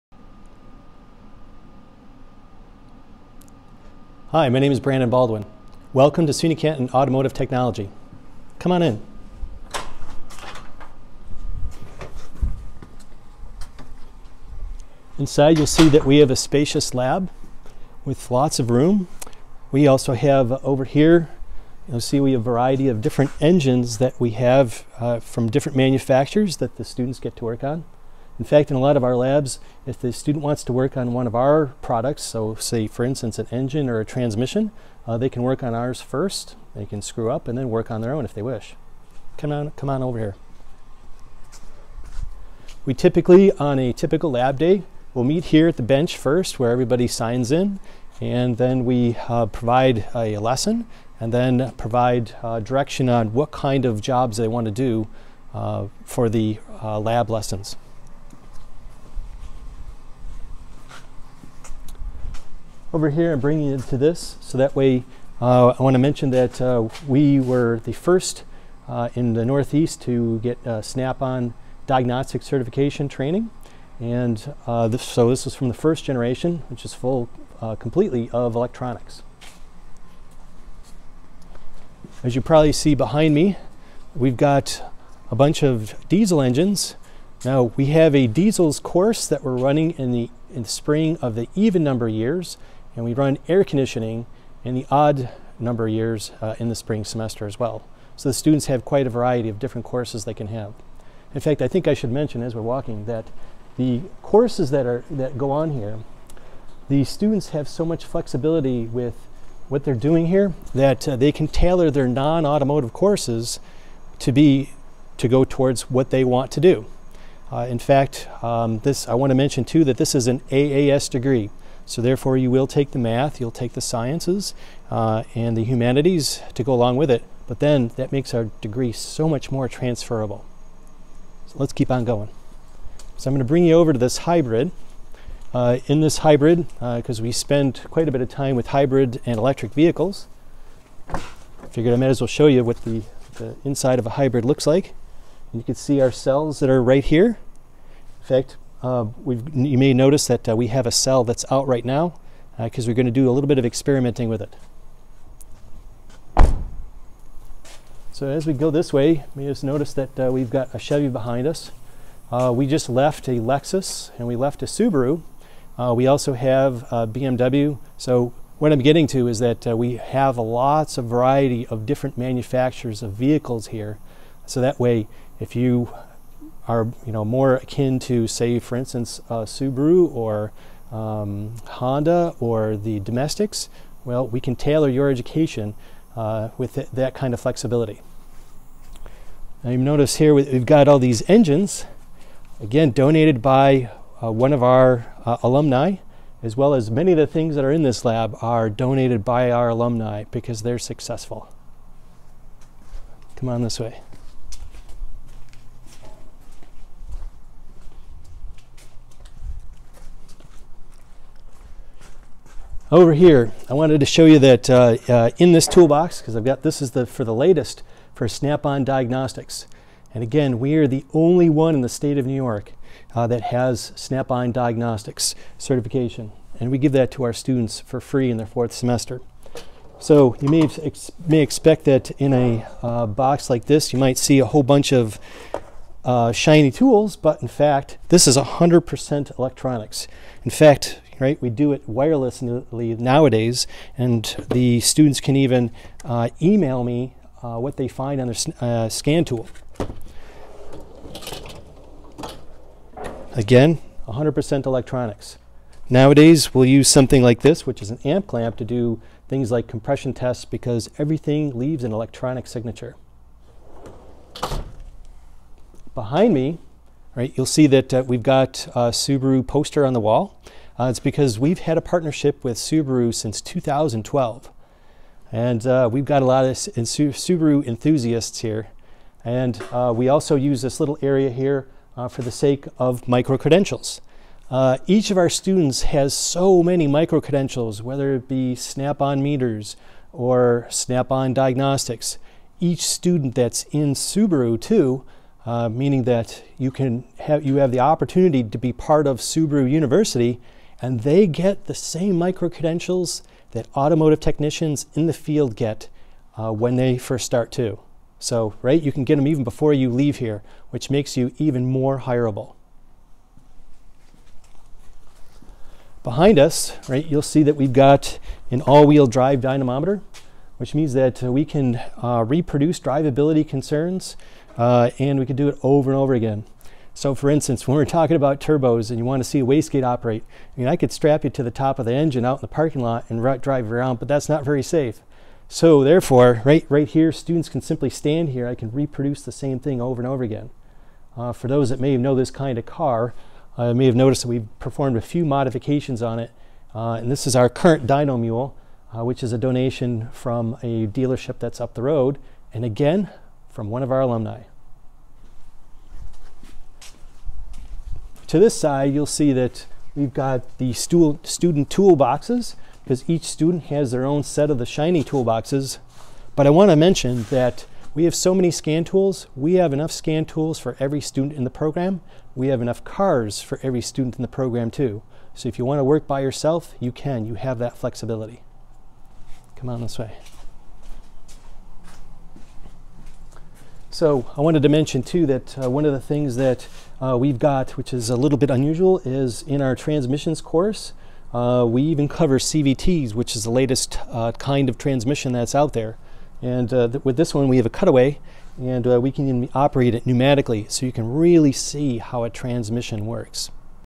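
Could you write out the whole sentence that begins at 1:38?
So the students have quite a variety of different courses they can have.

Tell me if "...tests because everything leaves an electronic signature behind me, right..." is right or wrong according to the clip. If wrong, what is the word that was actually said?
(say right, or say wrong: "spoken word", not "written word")
right.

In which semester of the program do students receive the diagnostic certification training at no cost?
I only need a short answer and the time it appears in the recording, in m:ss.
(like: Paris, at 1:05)
fourth semester, at 3:48.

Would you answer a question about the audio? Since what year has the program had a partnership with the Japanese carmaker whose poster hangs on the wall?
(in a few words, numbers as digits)
2012.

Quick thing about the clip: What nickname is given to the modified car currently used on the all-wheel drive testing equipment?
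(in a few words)
Dyno Mule.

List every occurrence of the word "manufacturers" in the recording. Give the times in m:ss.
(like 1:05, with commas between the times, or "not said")
0:25, 2:52.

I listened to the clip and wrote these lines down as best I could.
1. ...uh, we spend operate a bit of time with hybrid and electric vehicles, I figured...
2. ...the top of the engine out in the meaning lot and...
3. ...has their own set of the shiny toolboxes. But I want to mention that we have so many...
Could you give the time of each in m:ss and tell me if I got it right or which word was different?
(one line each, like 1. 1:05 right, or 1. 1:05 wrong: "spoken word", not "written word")
1. 2:17 wrong: "quite", not "operate"
2. 5:31 wrong: "parking", not "meaning"
3. 6:03 right.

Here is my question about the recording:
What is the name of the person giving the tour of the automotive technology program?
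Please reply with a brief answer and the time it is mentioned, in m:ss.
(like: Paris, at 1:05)
Brandon Baldwin, at 0:04.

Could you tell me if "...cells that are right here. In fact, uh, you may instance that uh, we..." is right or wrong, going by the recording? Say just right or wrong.
wrong.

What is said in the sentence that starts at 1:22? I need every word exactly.
As you probably see behind me, we've got a bunch of diesel engines.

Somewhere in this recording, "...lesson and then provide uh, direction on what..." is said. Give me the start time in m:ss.
0:50.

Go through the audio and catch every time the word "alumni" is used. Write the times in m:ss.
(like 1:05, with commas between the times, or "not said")
3:15, 3:19, 5:54.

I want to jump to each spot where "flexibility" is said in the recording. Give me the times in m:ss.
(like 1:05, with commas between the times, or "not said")
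1:48, 3:07, 6:17.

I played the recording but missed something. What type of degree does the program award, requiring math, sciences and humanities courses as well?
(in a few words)
AAS.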